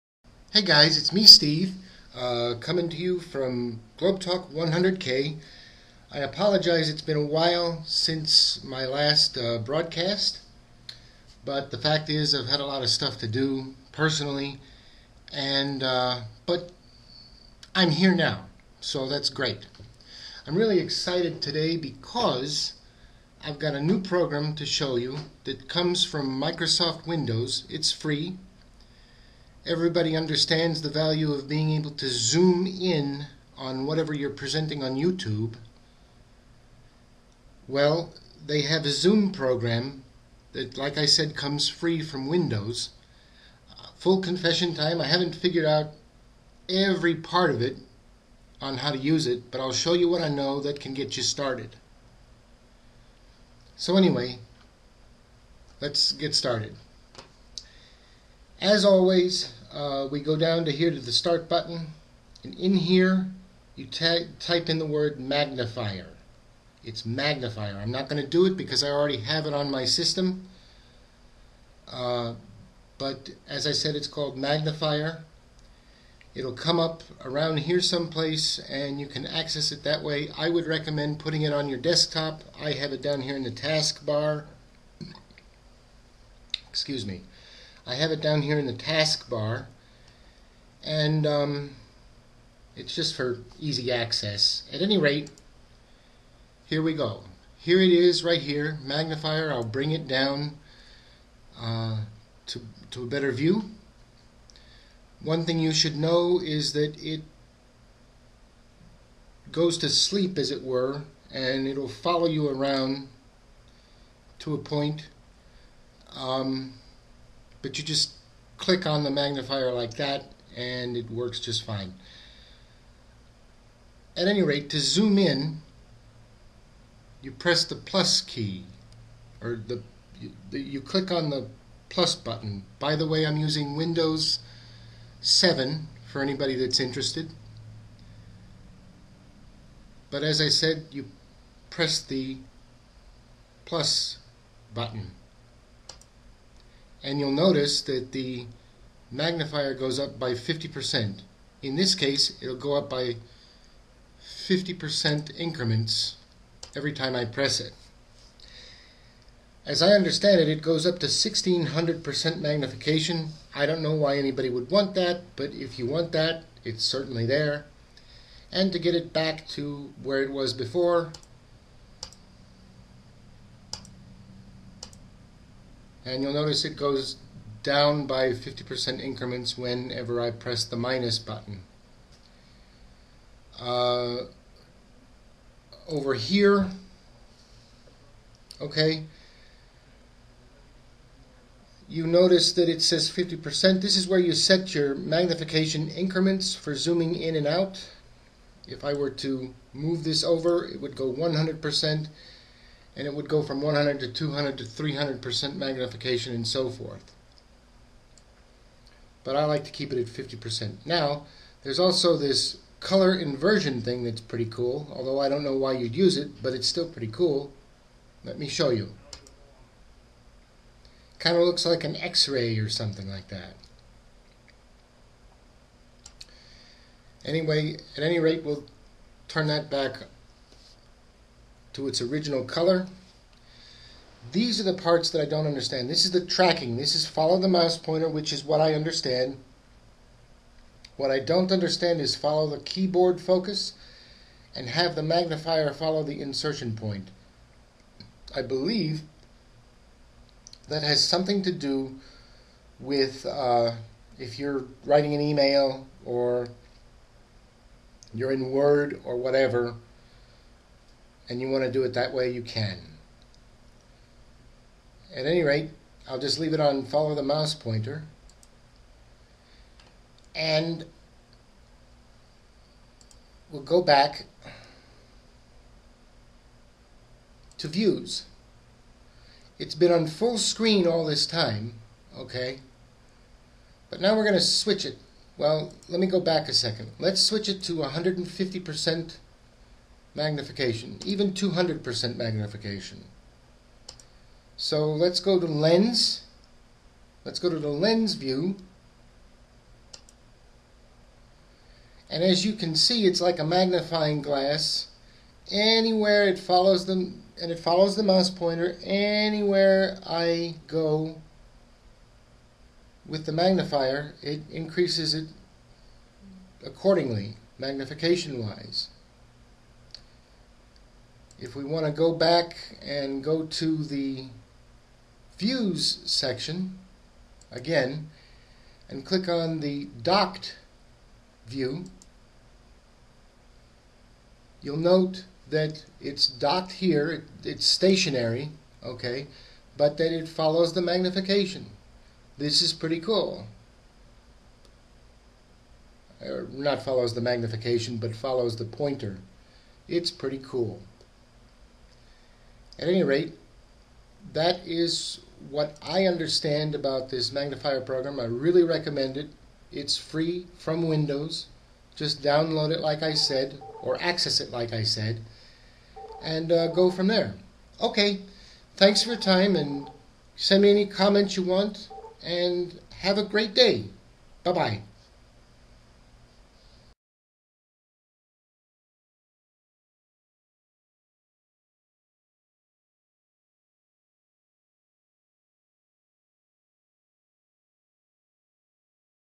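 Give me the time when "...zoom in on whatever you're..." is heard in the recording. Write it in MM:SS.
00:32.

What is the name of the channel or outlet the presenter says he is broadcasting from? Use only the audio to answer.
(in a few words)
Globe Talk 100K.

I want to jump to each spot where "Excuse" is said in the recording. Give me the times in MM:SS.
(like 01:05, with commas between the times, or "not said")
01:26.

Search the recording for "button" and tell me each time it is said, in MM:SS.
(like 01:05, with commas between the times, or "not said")
01:01, 02:12, 02:24, 03:01.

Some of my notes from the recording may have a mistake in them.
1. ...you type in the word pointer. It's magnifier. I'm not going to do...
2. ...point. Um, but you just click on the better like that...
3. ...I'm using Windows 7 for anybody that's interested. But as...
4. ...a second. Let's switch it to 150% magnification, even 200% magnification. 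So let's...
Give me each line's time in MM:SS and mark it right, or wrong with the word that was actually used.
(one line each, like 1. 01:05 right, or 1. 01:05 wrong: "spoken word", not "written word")
1. 01:03 wrong: "magnifier", not "pointer"
2. 01:54 wrong: "magnifier", not "better"
3. 02:13 right
4. 04:46 right.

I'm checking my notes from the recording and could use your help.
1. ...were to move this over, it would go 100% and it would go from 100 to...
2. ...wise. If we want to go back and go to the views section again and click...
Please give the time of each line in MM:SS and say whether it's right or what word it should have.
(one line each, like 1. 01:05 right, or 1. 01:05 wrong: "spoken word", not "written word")
1. 03:18 right
2. 05:18 right.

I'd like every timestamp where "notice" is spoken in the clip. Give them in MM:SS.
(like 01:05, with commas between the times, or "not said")
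02:27, 02:56, 03:12.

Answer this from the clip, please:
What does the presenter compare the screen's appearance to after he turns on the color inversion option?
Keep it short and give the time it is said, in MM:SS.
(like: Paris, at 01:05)
an x-ray, at 03:41.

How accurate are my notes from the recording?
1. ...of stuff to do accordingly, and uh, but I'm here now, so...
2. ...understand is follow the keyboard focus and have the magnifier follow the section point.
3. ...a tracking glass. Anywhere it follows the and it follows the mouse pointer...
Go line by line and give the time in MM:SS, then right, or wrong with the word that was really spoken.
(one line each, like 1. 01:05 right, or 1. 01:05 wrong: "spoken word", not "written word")
1. 00:12 wrong: "personally", not "accordingly"
2. 04:01 wrong: "insertion", not "section"
3. 05:03 wrong: "magnifying", not "tracking".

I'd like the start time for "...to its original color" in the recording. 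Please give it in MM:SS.
03:51.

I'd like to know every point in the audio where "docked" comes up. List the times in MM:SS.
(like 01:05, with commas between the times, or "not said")
05:30, 05:36.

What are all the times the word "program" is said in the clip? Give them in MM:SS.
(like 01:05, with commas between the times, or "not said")
00:24, 00:39, 05:57.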